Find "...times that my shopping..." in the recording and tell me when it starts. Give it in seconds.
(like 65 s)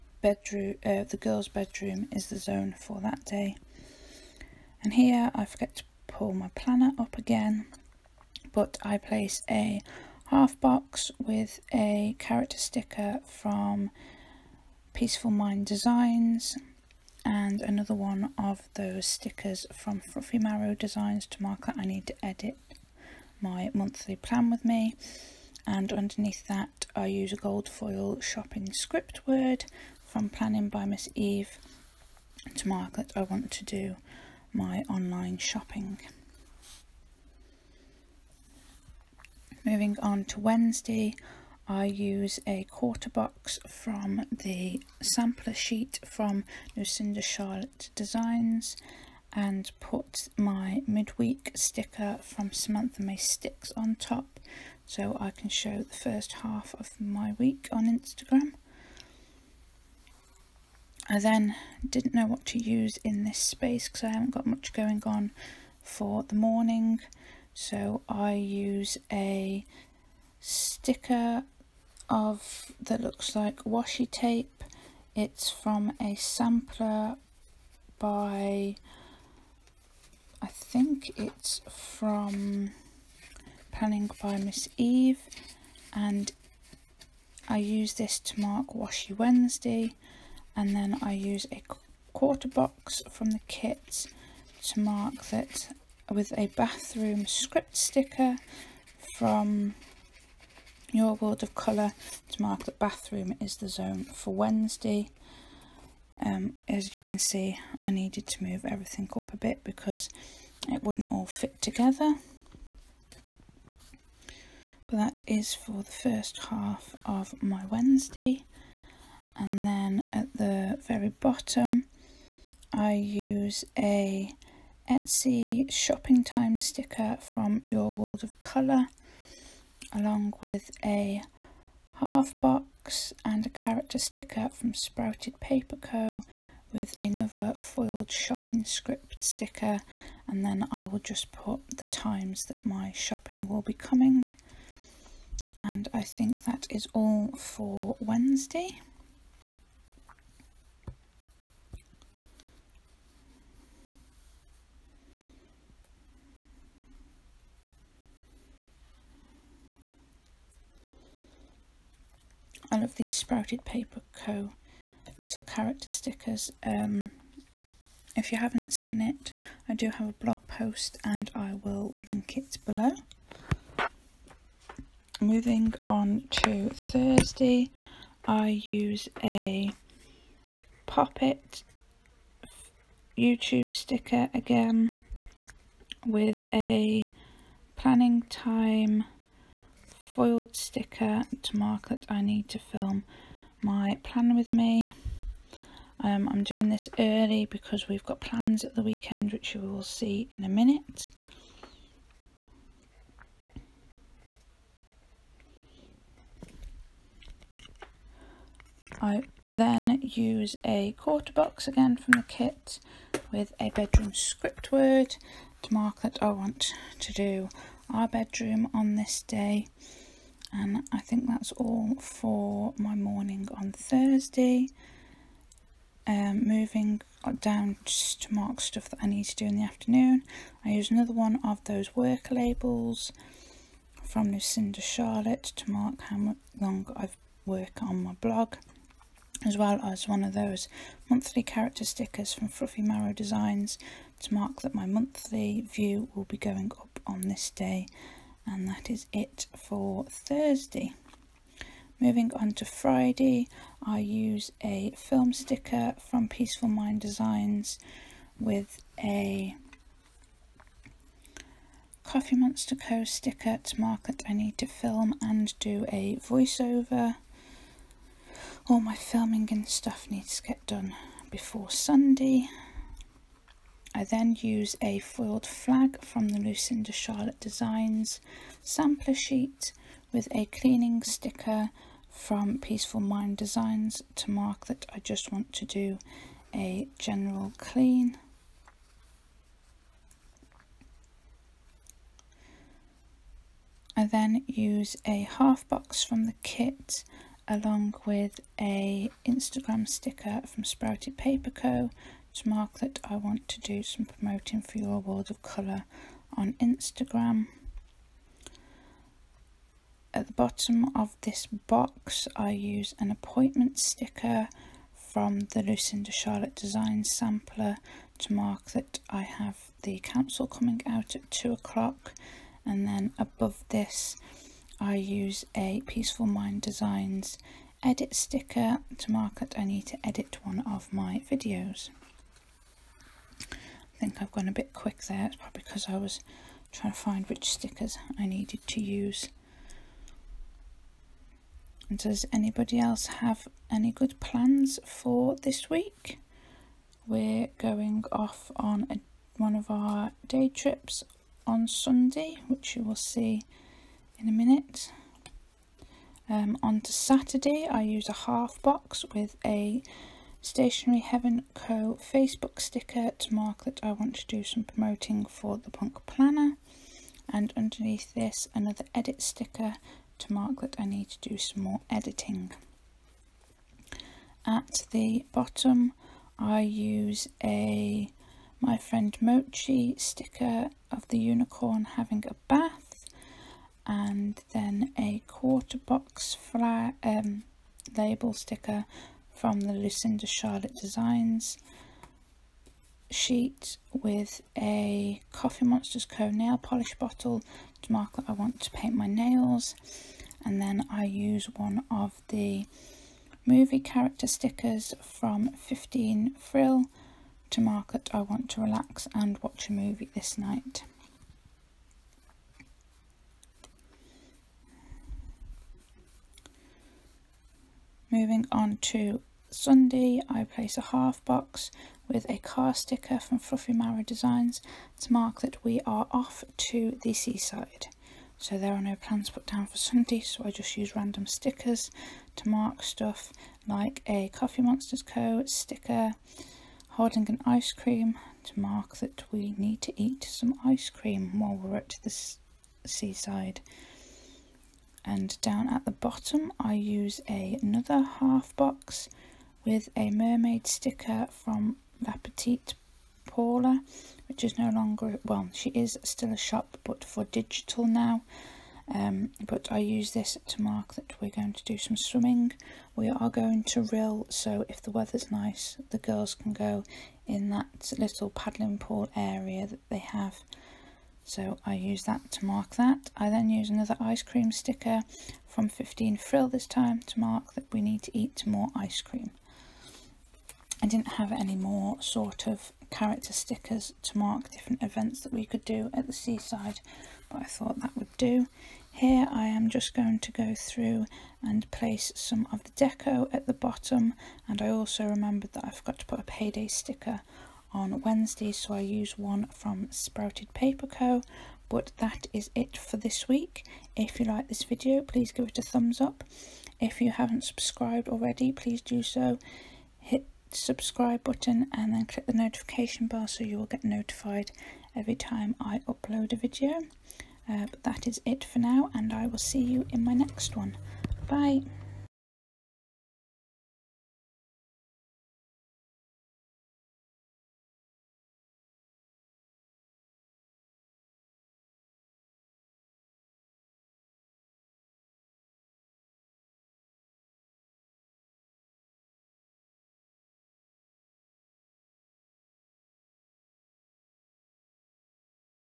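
141 s.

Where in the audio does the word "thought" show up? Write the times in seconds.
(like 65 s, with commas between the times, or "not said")
487 s.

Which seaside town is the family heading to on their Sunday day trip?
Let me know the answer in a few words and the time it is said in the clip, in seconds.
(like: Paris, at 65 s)
Rhyl, at 463 s.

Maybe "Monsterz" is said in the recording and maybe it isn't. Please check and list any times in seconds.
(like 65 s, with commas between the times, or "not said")
262 s, 395 s, 434 s.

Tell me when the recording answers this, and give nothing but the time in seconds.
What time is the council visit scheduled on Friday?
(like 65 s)
321 s.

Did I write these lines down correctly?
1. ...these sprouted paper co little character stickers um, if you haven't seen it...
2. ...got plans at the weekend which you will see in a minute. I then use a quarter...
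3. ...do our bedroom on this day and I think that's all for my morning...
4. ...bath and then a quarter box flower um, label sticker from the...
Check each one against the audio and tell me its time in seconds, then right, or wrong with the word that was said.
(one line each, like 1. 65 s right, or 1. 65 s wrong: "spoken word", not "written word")
1. 162 s right
2. 198 s right
3. 217 s right
4. 382 s right.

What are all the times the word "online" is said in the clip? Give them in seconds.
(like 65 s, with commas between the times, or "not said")
34 s.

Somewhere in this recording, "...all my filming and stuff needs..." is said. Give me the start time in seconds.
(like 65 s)
268 s.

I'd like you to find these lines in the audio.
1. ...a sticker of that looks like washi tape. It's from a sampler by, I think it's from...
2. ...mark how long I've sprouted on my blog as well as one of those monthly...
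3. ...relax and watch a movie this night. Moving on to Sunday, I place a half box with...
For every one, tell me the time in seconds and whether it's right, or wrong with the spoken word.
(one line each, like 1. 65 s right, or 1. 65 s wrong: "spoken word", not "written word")
1. 69 s right
2. 235 s wrong: "worked", not "sprouted"
3. 408 s right.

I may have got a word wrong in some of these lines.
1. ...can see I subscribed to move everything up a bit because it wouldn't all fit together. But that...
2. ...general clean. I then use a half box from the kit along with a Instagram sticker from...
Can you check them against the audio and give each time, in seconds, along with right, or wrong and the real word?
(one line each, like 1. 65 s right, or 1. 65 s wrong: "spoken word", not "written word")
1. 107 s wrong: "needed", not "subscribed"
2. 286 s right.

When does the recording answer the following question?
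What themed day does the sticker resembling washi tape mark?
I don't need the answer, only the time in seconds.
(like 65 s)
88 s.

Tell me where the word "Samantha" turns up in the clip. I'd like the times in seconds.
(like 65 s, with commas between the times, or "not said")
52 s.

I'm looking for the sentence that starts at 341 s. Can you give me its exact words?
And does anybody else have any good plans for this week?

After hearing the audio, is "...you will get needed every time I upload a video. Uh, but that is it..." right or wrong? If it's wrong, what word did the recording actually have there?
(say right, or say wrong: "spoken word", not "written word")
wrong: "notified", not "needed".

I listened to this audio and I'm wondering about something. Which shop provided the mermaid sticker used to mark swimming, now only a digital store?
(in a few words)
La Petite Paula.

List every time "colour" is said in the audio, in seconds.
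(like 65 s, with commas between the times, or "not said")
101 s, 128 s, 305 s.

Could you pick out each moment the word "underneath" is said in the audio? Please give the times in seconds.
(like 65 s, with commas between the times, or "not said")
25 s, 367 s.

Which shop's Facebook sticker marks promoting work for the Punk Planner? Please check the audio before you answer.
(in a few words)
Stationery Heaven Co.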